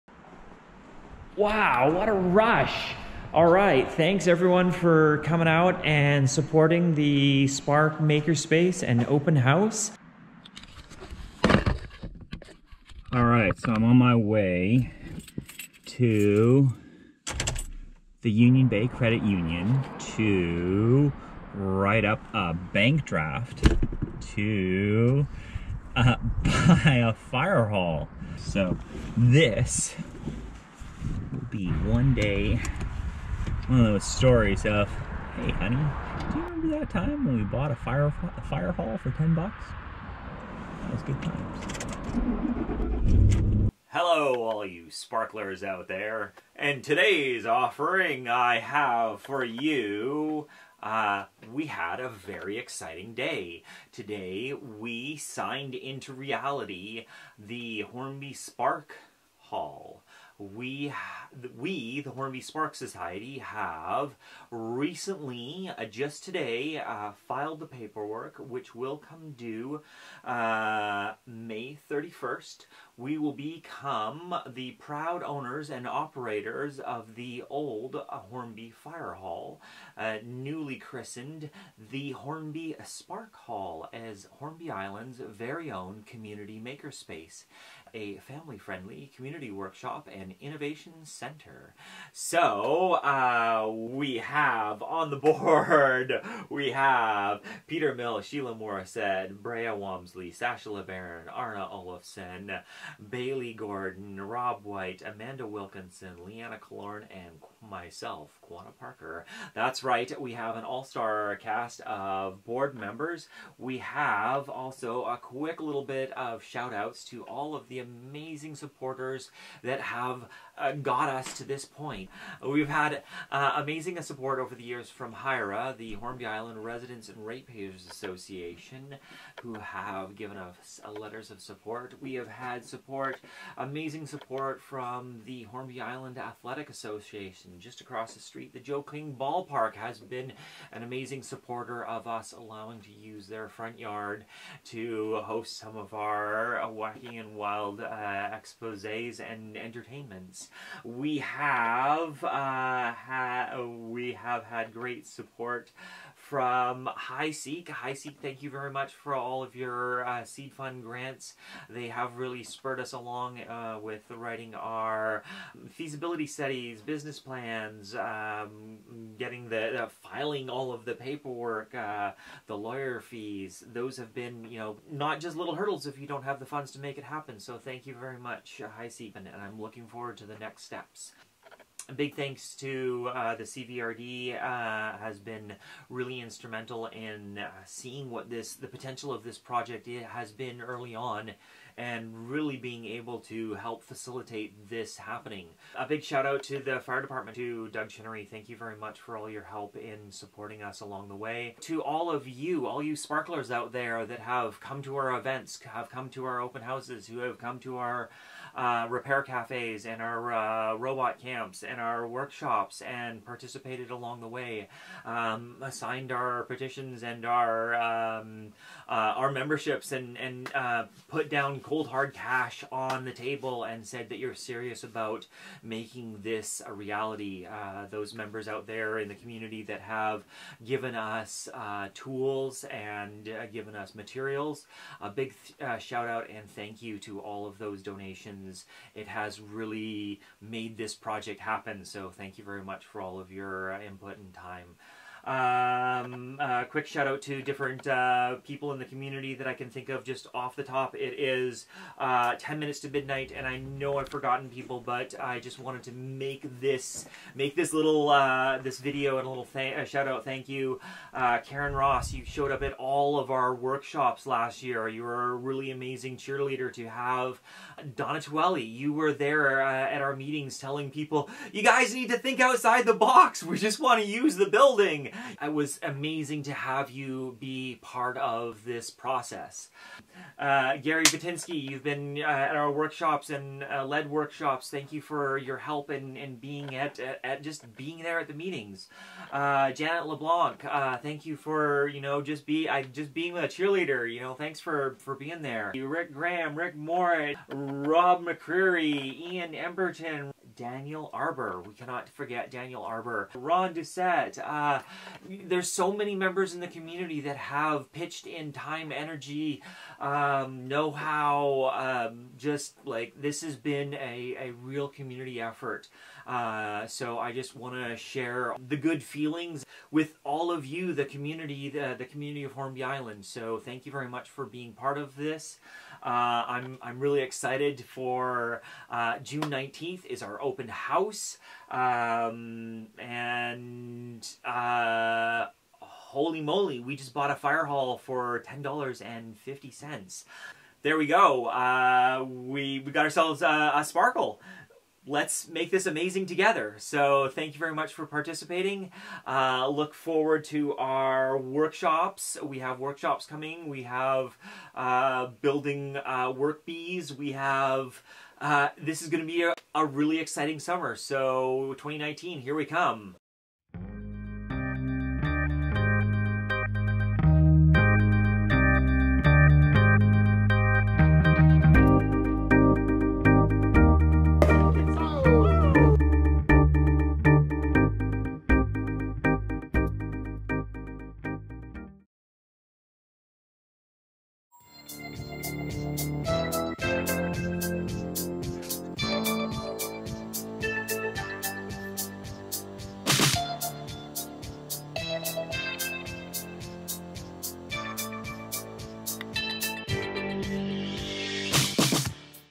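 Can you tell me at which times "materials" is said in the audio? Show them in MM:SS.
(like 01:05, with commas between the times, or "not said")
03:53.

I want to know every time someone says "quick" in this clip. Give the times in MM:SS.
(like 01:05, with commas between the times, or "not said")
01:55, 04:06.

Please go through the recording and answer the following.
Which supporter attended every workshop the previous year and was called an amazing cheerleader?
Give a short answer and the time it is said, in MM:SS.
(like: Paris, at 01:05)
Karen Ross, at 04:21.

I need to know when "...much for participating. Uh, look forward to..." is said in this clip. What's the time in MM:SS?
05:47.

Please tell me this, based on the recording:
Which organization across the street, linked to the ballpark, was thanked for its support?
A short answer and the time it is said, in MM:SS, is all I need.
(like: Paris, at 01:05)
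Hornby Island Athletic Association, at 02:15.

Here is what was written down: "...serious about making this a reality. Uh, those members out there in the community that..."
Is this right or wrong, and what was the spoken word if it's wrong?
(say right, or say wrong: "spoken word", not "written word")
right.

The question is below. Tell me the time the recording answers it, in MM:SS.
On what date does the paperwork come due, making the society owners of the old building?
01:11.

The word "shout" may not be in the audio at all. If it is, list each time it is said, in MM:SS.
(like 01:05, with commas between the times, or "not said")
01:56, 03:16, 03:55, 04:06, 04:19.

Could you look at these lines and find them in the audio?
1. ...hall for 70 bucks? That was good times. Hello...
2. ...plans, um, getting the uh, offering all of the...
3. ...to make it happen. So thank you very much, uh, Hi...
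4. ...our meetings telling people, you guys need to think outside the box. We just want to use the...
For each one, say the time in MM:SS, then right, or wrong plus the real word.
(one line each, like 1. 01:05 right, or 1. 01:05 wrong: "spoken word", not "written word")
1. 00:38 wrong: "10", not "70"
2. 02:47 wrong: "filing", not "offering"
3. 02:56 right
4. 04:30 right.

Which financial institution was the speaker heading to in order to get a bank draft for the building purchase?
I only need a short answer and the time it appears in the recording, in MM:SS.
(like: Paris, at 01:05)
Union Bay Credit Union, at 00:18.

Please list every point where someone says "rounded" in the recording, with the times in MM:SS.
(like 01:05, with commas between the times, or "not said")
not said.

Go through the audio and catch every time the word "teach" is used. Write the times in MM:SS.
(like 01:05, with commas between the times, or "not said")
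not said.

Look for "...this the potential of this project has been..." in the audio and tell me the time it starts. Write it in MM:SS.
03:08.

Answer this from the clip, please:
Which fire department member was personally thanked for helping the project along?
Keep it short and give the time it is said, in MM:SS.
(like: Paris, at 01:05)
Doug Chinnery, at 03:17.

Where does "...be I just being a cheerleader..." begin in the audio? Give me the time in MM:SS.
04:52.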